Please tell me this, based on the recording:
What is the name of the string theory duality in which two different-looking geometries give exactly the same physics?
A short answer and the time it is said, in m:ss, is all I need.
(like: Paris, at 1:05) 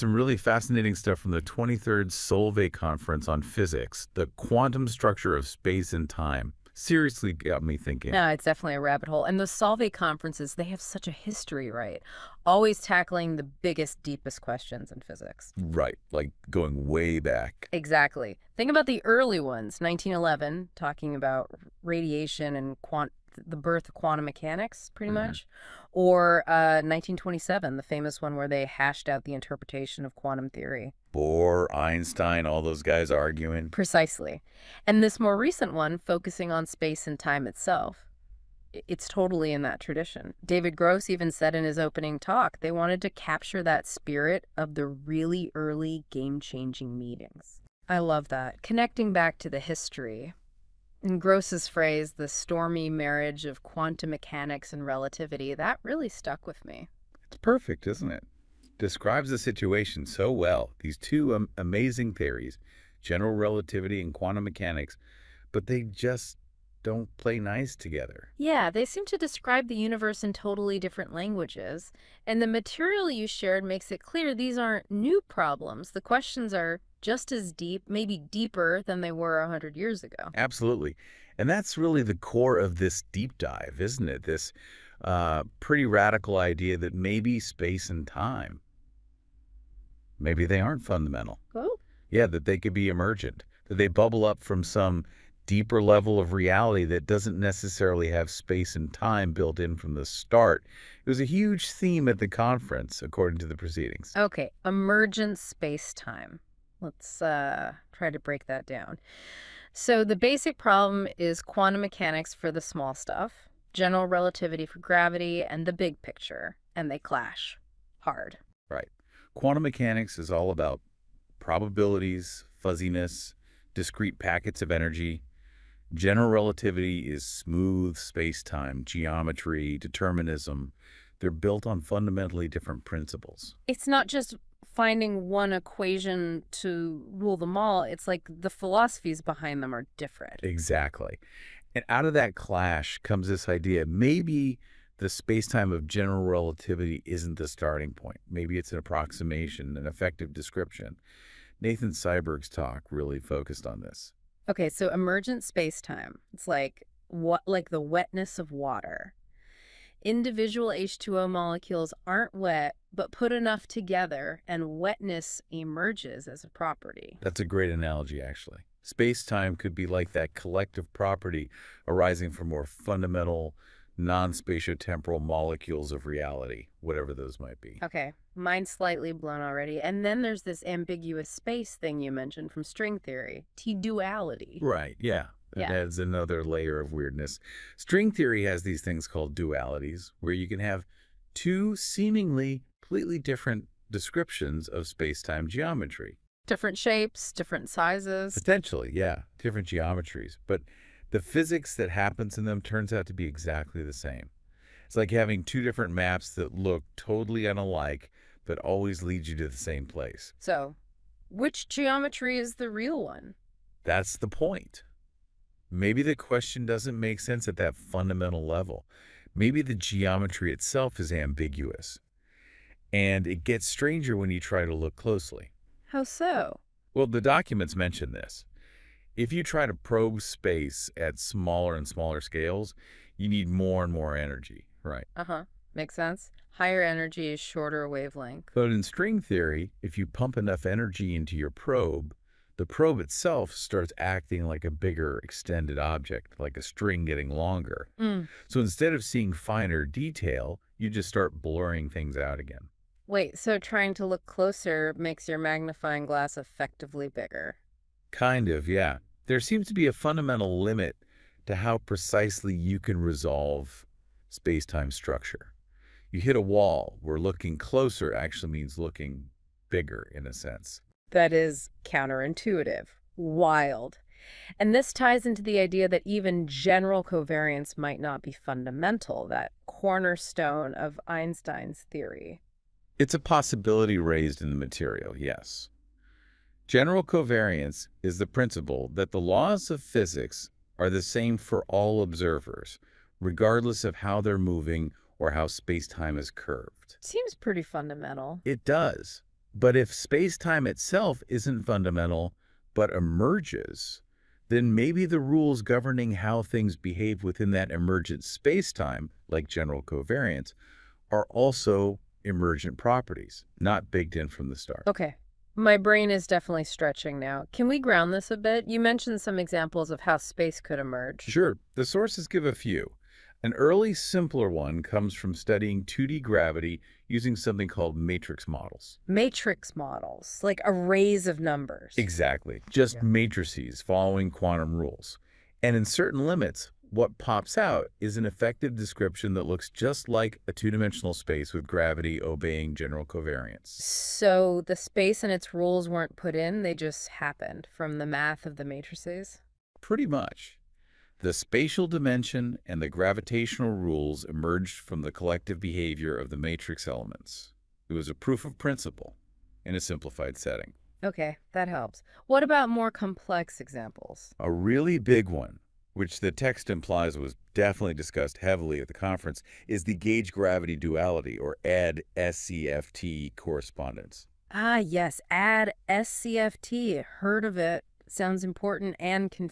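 T-duality, at 3:03.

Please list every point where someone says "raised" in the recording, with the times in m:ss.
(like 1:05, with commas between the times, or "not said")
4:43.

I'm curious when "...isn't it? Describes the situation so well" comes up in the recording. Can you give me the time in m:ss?
0:57.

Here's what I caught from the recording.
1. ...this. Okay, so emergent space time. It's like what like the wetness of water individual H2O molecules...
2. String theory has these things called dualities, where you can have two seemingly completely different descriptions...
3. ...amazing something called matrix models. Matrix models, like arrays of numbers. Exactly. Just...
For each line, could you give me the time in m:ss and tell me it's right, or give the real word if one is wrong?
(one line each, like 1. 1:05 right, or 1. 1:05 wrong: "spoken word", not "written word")
1. 2:33 right
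2. 3:07 right
3. 5:27 wrong: "using", not "amazing".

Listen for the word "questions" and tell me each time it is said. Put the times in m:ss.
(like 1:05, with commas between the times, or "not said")
0:14, 1:16, 3:36.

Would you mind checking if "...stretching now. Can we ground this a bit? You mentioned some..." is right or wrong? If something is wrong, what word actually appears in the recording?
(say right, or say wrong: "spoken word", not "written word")
right.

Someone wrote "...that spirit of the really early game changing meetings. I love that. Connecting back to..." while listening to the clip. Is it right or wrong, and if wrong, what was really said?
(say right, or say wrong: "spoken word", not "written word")
right.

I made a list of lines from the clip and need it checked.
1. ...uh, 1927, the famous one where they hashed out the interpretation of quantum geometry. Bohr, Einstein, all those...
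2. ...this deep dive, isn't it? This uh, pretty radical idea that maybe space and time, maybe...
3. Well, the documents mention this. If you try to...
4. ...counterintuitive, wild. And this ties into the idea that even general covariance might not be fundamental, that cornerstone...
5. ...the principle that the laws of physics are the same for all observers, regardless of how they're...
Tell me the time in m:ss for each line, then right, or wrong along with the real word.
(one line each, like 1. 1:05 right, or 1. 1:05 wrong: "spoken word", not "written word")
1. 0:26 wrong: "theory", not "geometry"
2. 1:22 right
3. 3:46 right
4. 4:31 right
5. 4:48 right.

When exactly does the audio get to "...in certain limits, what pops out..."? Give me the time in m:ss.
5:35.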